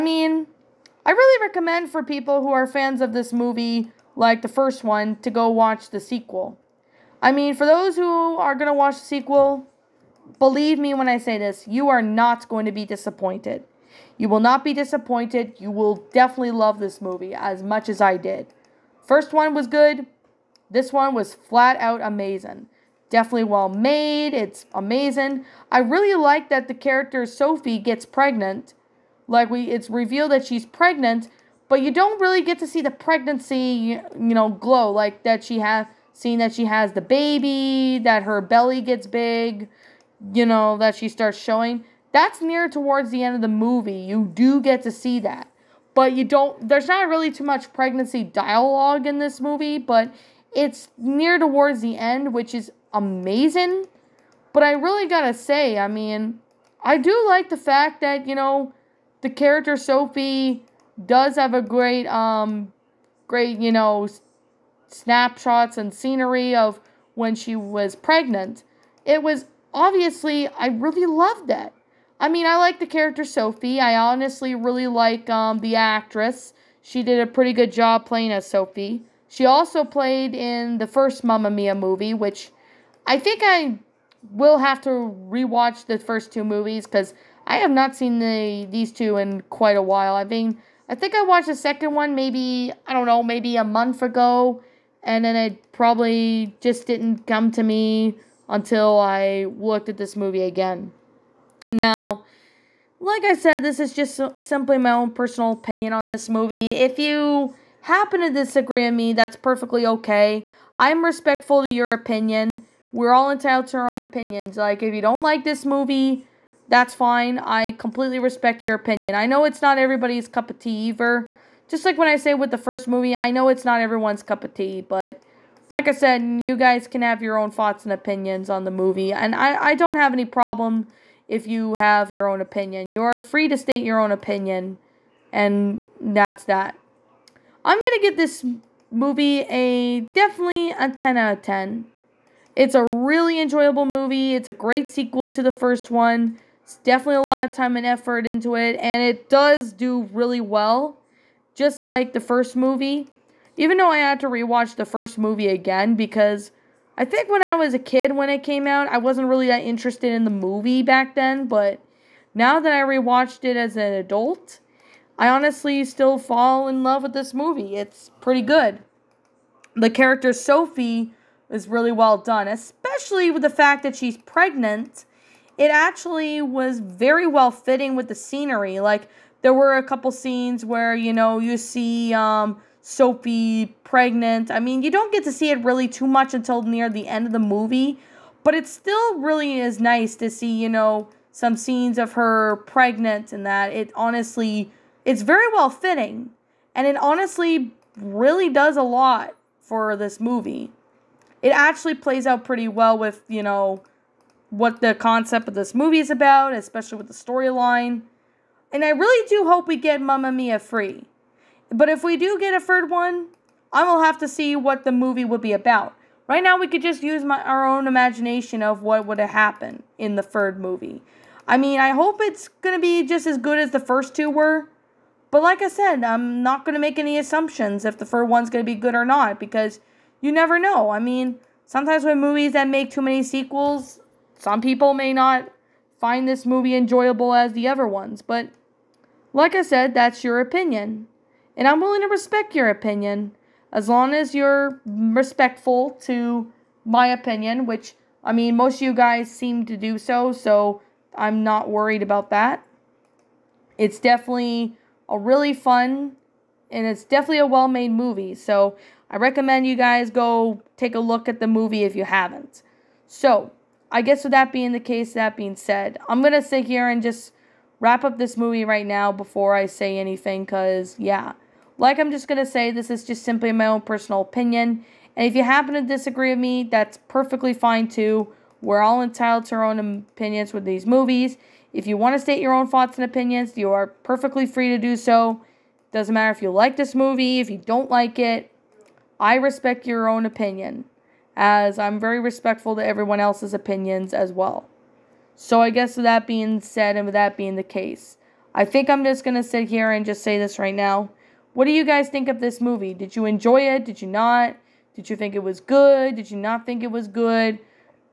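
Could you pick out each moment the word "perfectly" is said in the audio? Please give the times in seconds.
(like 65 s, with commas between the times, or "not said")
109 s, 277 s, 283 s.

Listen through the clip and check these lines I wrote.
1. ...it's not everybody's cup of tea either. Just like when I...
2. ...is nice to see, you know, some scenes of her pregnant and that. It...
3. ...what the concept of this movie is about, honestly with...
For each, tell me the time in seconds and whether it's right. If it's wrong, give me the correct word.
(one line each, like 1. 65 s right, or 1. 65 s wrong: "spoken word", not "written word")
1. 119 s right
2. 189 s right
3. 204 s wrong: "especially", not "honestly".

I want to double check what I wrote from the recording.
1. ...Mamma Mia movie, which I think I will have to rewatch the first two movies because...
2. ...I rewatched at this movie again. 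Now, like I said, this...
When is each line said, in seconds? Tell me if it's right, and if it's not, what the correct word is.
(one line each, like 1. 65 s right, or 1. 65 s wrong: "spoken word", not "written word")
1. 81 s right
2. 98 s wrong: "looked", not "rewatched".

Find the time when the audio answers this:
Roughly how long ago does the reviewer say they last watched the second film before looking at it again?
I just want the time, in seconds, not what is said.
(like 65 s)
93 s.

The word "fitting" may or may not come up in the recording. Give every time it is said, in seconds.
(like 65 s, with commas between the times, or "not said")
177 s, 195 s.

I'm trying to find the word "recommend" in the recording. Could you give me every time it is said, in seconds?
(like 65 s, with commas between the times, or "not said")
1 s, 259 s.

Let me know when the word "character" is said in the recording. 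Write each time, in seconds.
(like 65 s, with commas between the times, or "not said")
26 s, 59 s, 72 s, 169 s.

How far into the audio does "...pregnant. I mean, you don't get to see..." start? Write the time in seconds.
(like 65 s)
183 s.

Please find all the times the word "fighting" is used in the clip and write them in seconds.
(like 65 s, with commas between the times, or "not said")
not said.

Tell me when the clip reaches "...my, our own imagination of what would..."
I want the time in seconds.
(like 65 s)
217 s.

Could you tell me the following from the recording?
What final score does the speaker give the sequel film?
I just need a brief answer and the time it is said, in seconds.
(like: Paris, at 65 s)
10 out of 10, at 140 s.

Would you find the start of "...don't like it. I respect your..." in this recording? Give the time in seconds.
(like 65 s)
287 s.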